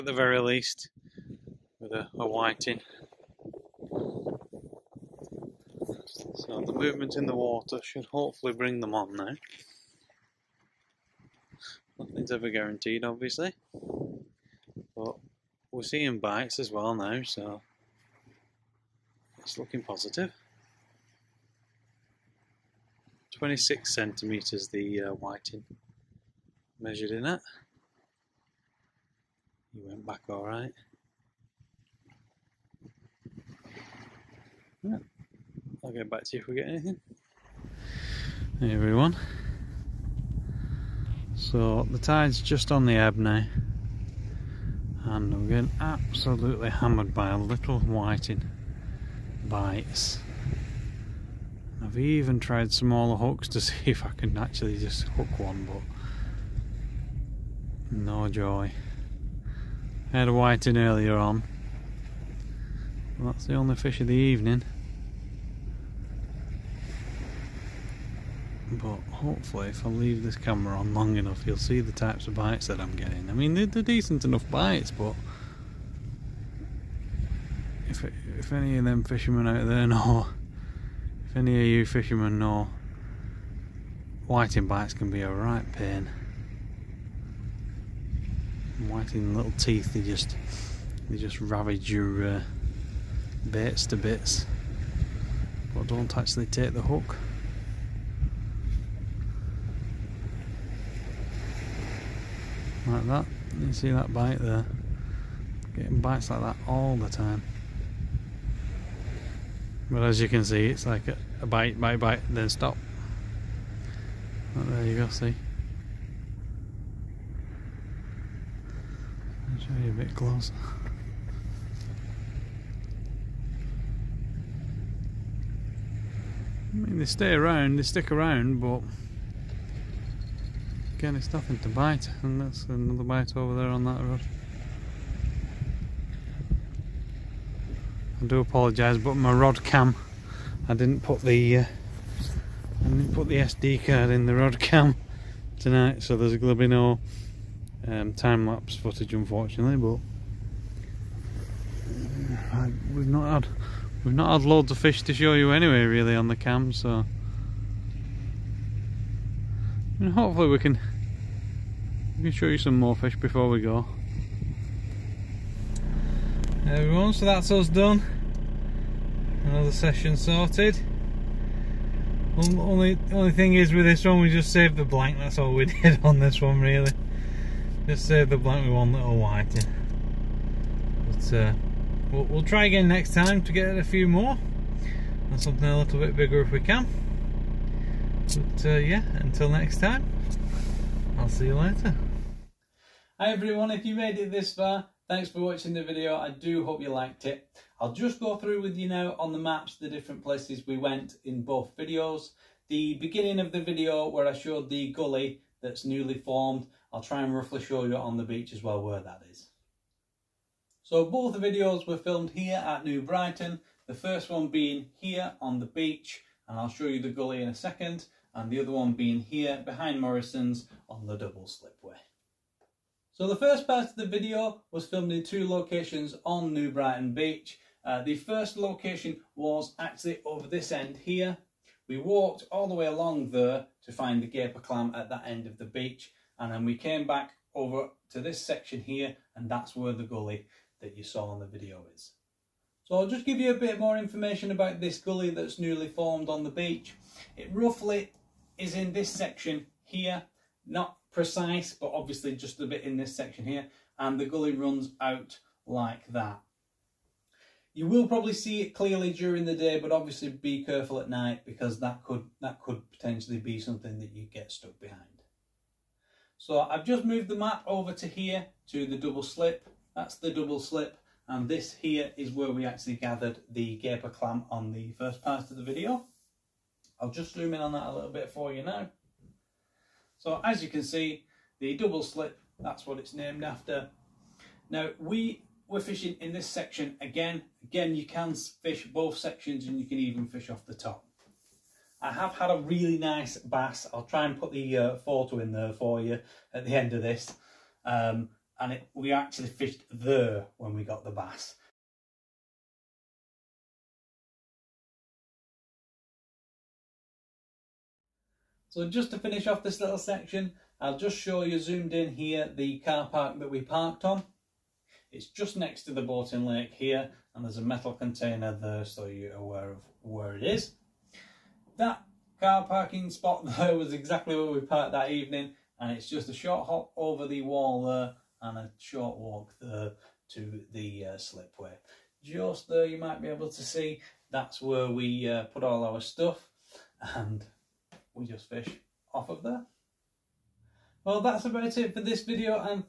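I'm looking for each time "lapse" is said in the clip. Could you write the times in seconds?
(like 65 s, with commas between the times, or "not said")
148 s.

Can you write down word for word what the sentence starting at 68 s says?
But hopefully if I leave this camera on long enough you'll see the types of bites that I'm getting.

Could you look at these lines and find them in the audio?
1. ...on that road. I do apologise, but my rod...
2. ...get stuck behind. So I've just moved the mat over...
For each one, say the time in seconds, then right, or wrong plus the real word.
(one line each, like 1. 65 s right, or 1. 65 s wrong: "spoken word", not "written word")
1. 133 s right
2. 264 s right.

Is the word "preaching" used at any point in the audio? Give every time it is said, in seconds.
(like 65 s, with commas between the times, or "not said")
not said.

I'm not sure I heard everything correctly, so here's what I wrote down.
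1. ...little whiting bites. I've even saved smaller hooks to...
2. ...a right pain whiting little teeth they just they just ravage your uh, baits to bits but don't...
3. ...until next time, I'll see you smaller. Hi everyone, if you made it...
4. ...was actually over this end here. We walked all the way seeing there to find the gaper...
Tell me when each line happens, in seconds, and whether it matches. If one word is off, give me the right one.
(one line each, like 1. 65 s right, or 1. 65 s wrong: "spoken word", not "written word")
1. 47 s wrong: "tried", not "saved"
2. 85 s right
3. 189 s wrong: "later", not "smaller"
4. 229 s wrong: "along", not "seeing".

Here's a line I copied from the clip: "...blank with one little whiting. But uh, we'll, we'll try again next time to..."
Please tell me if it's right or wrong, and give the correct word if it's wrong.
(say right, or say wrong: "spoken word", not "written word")
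right.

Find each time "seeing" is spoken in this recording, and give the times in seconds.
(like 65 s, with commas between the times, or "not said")
15 s.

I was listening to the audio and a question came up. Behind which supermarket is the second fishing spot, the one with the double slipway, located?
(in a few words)
Morrison's.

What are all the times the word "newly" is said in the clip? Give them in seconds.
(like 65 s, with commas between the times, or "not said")
205 s, 245 s.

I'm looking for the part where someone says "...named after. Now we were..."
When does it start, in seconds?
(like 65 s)
283 s.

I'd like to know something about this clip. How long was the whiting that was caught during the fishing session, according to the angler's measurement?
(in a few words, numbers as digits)
26 centimetres.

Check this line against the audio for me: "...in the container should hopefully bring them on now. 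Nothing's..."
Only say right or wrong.
wrong.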